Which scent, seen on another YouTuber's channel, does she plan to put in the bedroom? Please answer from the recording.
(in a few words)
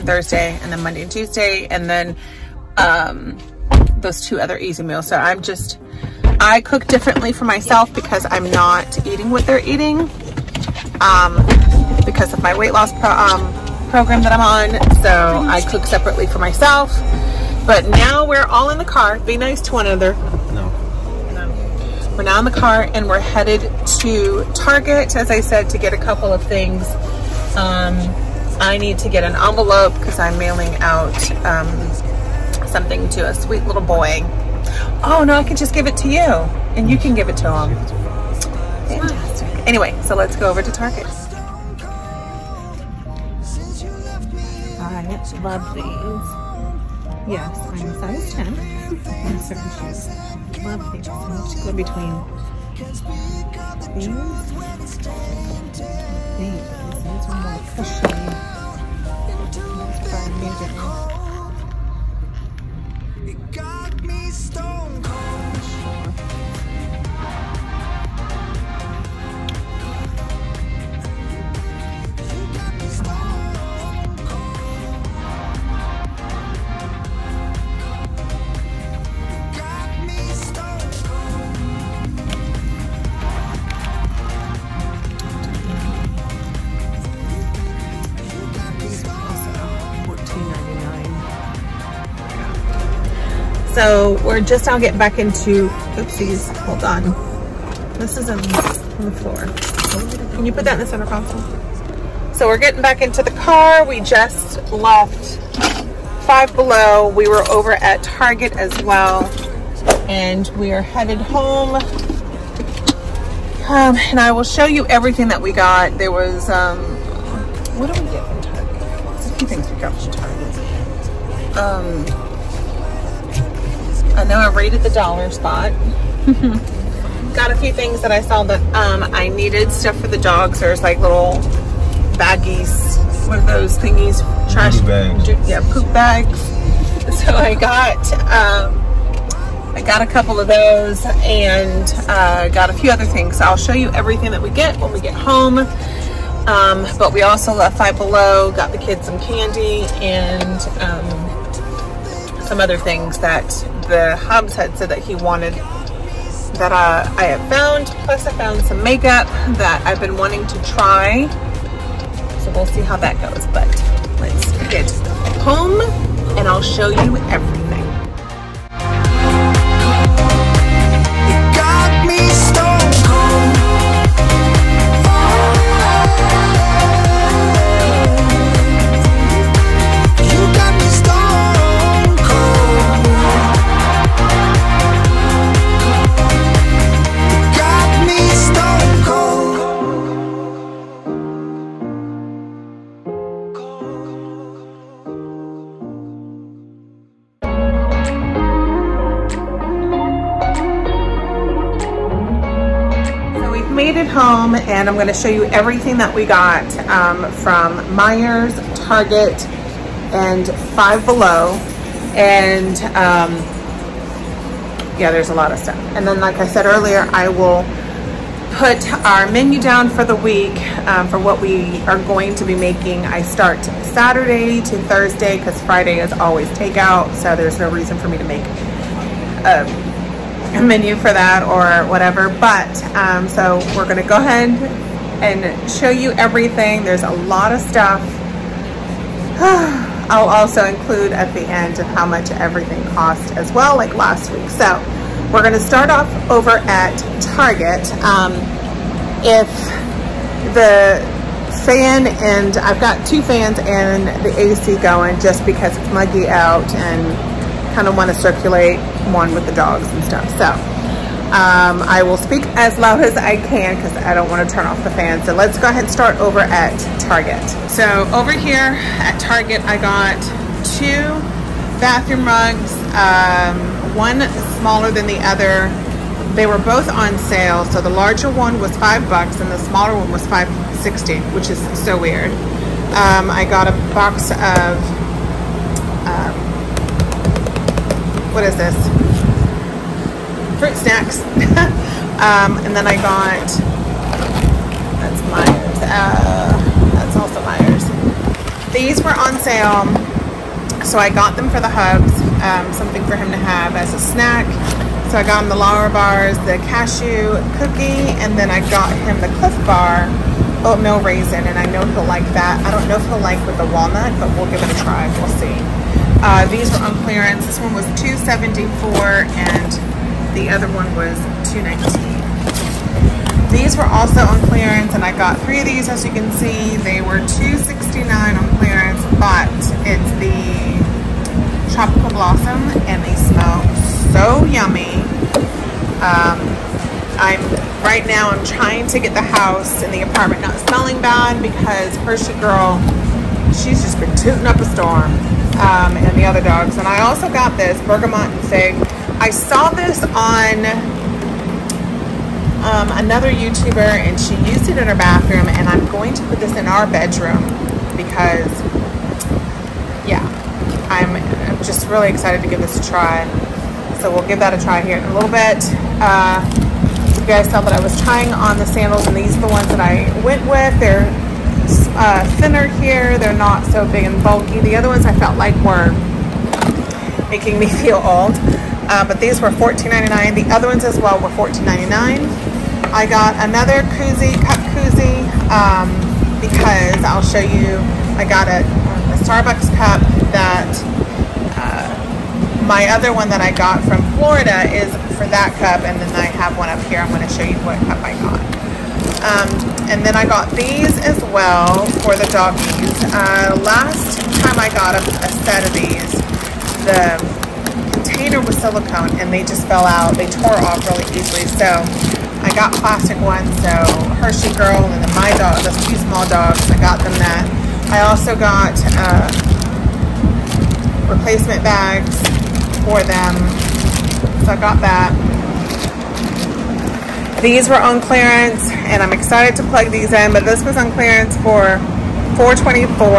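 Bergamot and fig.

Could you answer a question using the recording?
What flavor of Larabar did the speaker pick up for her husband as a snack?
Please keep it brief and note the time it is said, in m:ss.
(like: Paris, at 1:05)
Cashew cookie, at 5:06.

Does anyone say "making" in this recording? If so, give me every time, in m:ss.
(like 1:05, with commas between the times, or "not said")
3:42, 6:17.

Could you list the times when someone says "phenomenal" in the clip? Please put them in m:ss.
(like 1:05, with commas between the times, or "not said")
not said.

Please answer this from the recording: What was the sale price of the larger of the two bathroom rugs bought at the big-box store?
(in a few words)
$5.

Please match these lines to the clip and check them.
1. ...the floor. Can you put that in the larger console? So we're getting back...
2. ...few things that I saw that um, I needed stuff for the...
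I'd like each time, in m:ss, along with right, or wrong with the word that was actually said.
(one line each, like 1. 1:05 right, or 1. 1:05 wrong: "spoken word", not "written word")
1. 1:38 wrong: "center", not "larger"
2. 2:07 right.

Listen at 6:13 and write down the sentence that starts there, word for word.
They're not so big and bulky.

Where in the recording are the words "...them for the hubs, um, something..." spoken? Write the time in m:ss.
5:01.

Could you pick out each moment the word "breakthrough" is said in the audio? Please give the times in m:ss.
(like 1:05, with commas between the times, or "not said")
not said.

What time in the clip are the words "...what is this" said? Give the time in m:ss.
4:48.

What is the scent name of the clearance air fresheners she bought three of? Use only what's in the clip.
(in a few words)
Tropical Blossom.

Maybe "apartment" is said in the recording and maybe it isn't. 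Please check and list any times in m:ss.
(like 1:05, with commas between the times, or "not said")
5:40.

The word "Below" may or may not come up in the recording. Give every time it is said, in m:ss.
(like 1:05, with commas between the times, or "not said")
1:46, 2:27, 3:31.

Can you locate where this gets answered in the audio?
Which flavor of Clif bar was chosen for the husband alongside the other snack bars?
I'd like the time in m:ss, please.
5:10.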